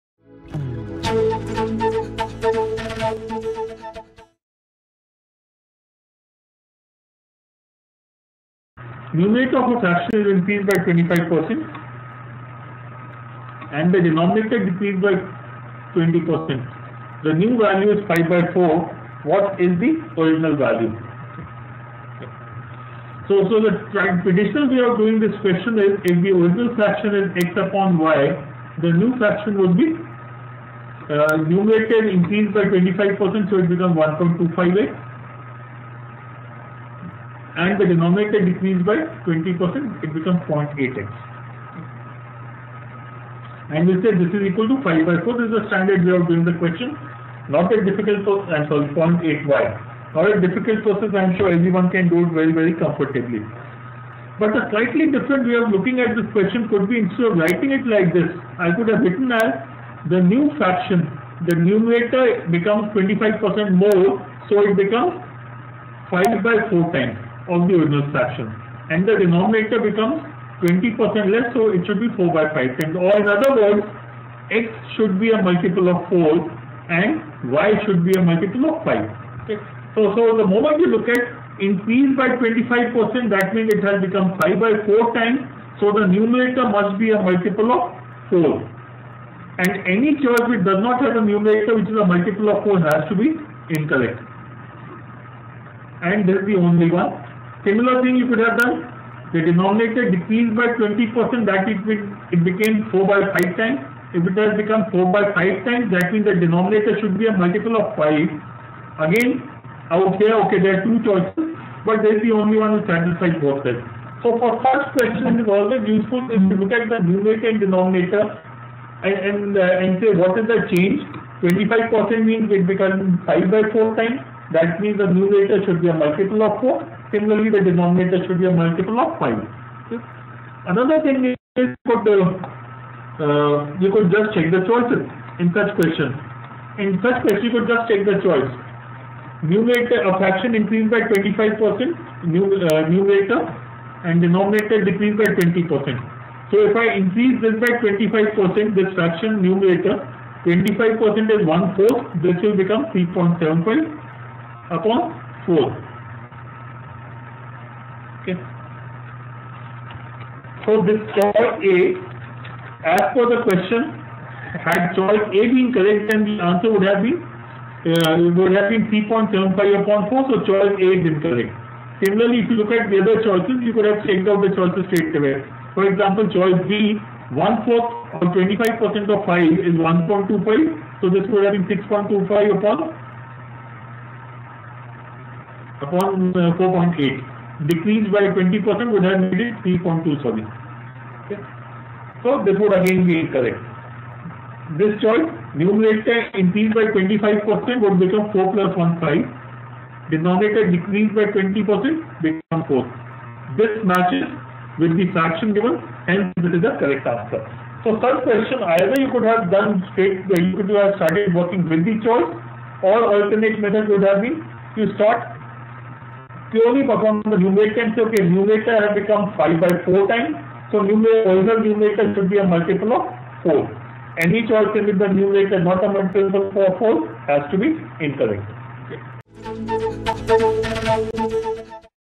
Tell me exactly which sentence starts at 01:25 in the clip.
So the numerator must be a multiple of 4.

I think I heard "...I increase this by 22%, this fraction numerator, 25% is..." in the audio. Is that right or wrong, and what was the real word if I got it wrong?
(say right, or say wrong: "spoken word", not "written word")
wrong: "25", not "22".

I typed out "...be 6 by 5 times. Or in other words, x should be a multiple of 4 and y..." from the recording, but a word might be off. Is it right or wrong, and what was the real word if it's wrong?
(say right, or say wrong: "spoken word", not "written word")
wrong: "4", not "6".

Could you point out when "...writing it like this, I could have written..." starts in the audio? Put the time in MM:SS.
00:57.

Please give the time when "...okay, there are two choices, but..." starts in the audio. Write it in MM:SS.
01:50.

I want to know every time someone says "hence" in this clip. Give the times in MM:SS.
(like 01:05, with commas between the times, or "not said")
03:26.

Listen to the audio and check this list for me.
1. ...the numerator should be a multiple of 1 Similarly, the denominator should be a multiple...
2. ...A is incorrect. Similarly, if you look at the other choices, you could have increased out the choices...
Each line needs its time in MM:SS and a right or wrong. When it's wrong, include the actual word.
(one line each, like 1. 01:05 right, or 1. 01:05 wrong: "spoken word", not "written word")
1. 02:04 wrong: "4", not "1"
2. 02:50 wrong: "checked", not "increased".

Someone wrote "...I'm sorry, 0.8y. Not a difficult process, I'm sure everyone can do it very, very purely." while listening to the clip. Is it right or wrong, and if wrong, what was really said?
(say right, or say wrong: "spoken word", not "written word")
wrong: "comfortably", not "purely".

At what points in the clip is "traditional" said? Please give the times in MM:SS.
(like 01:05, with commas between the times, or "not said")
00:24.